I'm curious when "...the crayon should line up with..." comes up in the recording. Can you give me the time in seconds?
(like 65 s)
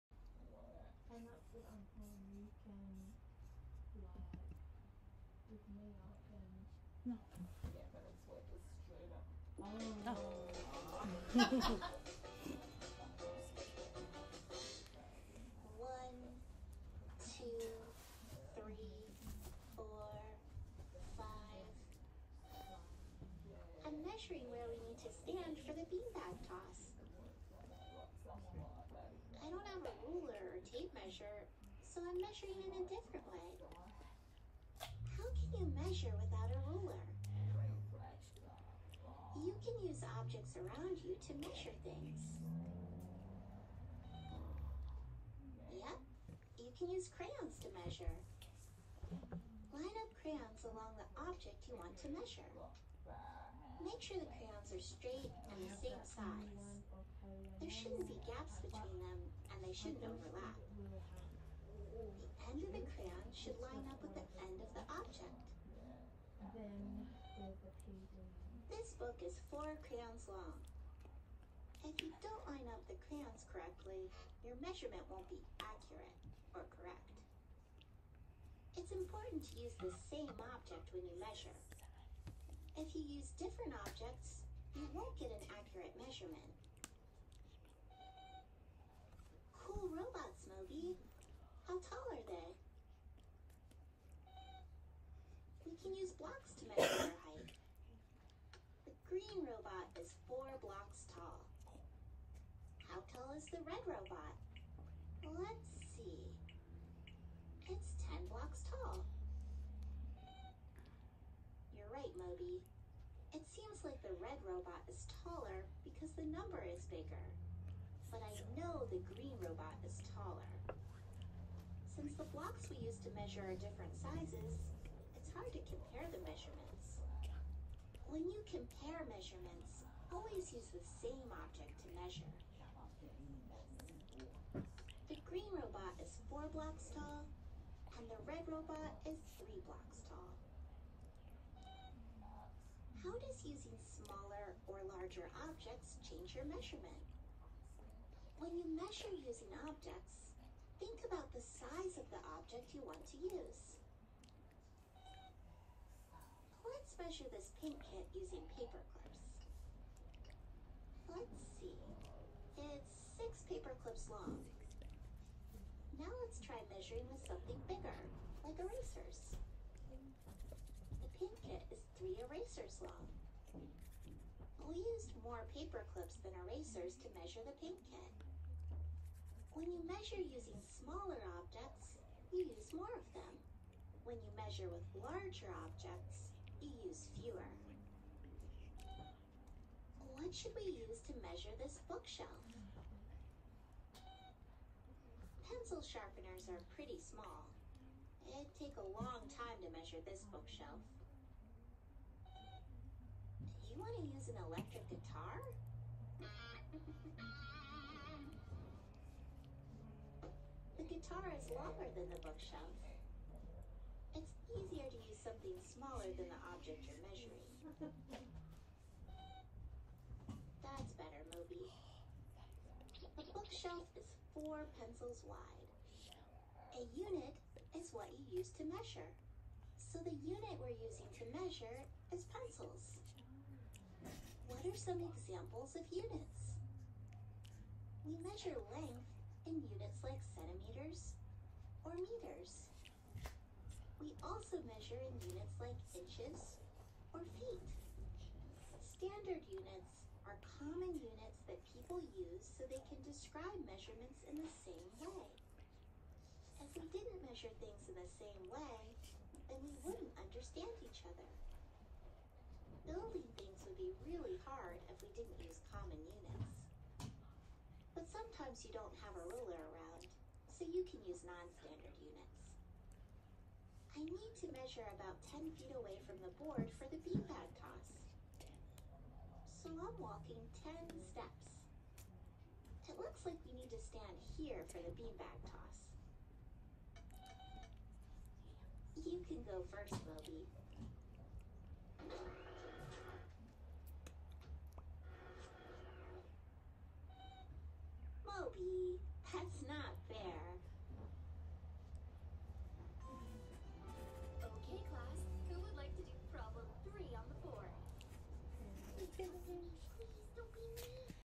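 62 s.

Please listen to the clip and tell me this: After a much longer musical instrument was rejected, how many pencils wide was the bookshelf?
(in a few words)
4.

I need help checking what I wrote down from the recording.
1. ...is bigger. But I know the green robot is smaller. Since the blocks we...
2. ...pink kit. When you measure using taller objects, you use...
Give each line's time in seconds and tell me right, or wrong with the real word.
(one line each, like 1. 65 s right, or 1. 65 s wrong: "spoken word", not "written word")
1. 116 s wrong: "taller", not "smaller"
2. 177 s wrong: "smaller", not "taller".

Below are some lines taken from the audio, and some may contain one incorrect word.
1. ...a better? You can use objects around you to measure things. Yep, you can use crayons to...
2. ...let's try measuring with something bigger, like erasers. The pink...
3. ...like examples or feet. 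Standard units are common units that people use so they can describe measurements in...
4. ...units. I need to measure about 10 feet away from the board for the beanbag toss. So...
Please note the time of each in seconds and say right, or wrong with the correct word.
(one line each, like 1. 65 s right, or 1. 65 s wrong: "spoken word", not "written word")
1. 36 s wrong: "ruler", not "better"
2. 166 s right
3. 245 s wrong: "inches", not "examples"
4. 272 s right.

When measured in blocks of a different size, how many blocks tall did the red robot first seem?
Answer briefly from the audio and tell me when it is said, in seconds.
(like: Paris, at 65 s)
10 blocks, at 108 s.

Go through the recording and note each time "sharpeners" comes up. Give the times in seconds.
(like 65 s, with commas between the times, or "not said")
195 s.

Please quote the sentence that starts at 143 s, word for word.
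How does using smaller or larger objects change your measurement?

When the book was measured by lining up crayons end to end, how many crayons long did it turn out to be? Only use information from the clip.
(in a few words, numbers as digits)
4.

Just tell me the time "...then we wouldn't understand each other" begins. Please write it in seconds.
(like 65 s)
259 s.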